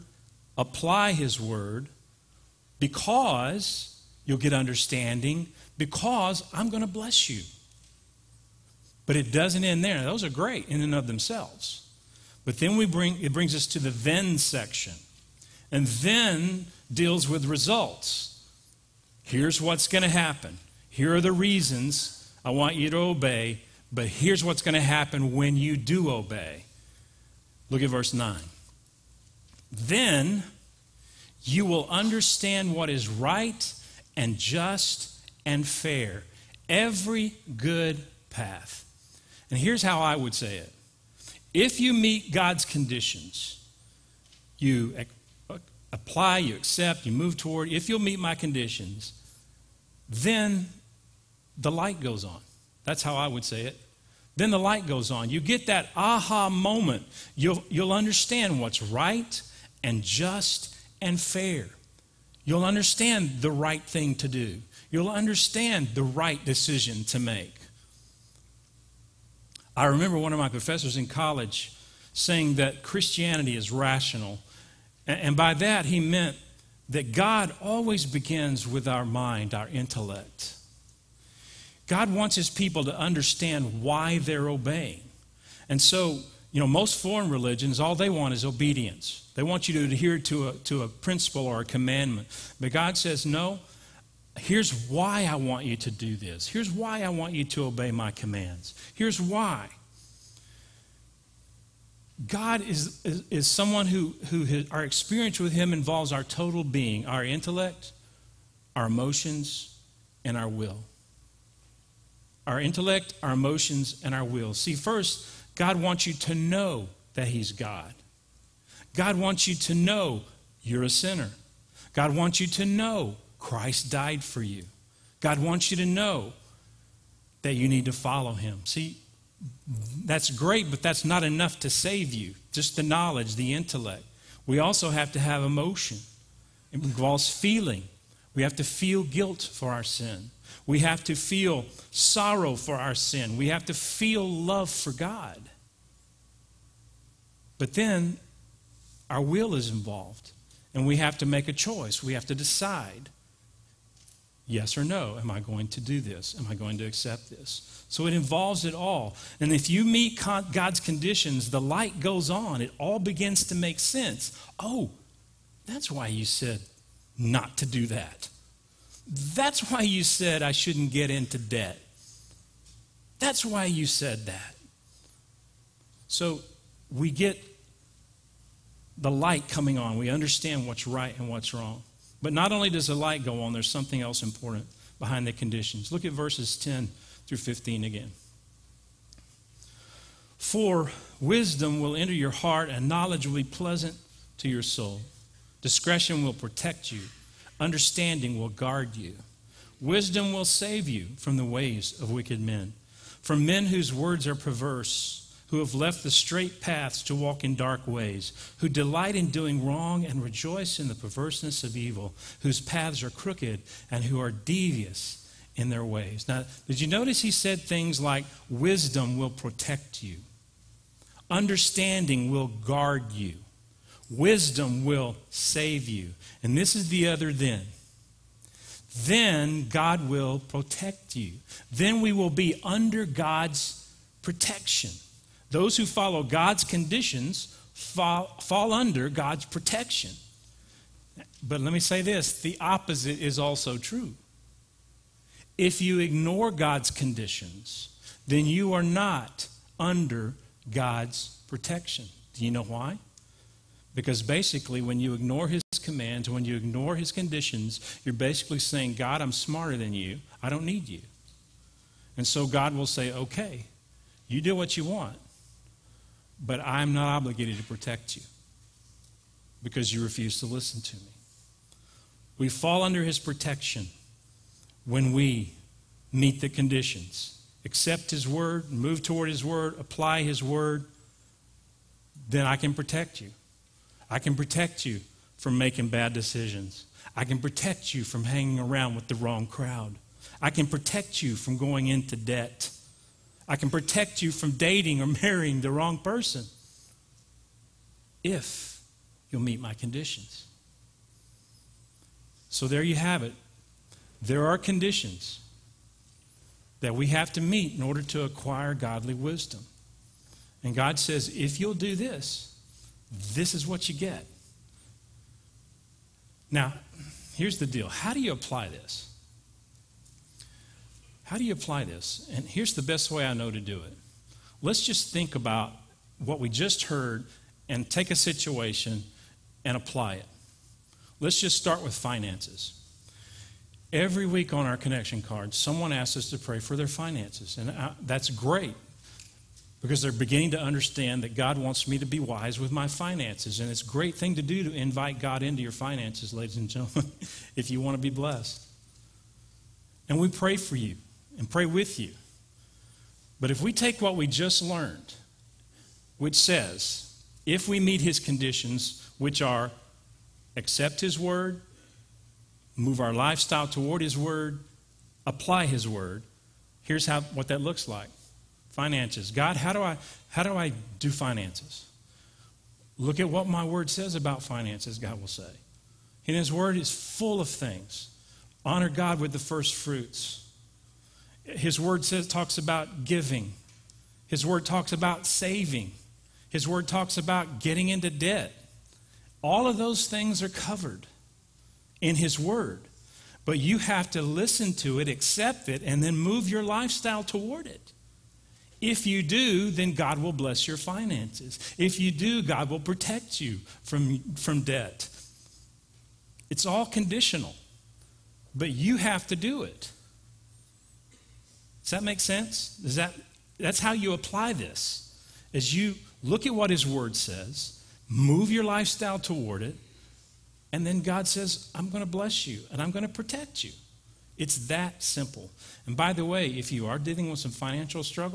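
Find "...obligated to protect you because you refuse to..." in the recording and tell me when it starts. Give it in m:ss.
4:27.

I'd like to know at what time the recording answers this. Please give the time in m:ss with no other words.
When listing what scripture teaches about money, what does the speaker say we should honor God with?
6:19.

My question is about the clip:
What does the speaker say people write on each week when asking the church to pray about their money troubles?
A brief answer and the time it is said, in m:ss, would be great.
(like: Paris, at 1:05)
connection card, at 5:34.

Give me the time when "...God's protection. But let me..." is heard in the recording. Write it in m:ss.
3:59.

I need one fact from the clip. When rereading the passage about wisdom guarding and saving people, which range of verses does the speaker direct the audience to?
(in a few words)
10 through 15.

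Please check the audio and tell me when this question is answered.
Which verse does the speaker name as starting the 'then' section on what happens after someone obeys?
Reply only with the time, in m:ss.
0:27.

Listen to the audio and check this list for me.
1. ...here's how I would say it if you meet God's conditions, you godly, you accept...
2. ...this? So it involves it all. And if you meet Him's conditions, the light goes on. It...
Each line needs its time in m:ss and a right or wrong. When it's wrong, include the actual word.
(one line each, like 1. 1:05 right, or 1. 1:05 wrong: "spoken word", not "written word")
1. 0:39 wrong: "apply", not "godly"
2. 2:37 wrong: "God", not "Him".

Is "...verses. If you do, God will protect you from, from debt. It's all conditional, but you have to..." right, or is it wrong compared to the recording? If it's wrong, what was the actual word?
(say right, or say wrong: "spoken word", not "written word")
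wrong: "finances", not "verses".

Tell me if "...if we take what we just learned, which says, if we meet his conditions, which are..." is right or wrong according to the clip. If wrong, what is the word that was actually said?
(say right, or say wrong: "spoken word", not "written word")
right.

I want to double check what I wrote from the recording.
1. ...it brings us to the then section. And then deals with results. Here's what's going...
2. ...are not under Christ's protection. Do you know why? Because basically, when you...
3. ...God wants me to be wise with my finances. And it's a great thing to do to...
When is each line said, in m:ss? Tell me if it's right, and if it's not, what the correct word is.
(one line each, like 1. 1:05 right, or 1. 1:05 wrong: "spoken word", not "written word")
1. 0:13 right
2. 4:08 wrong: "God", not "Christ"
3. 5:41 right.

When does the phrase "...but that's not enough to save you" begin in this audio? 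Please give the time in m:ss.
2:10.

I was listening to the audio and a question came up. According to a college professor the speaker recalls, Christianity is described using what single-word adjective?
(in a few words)
rational.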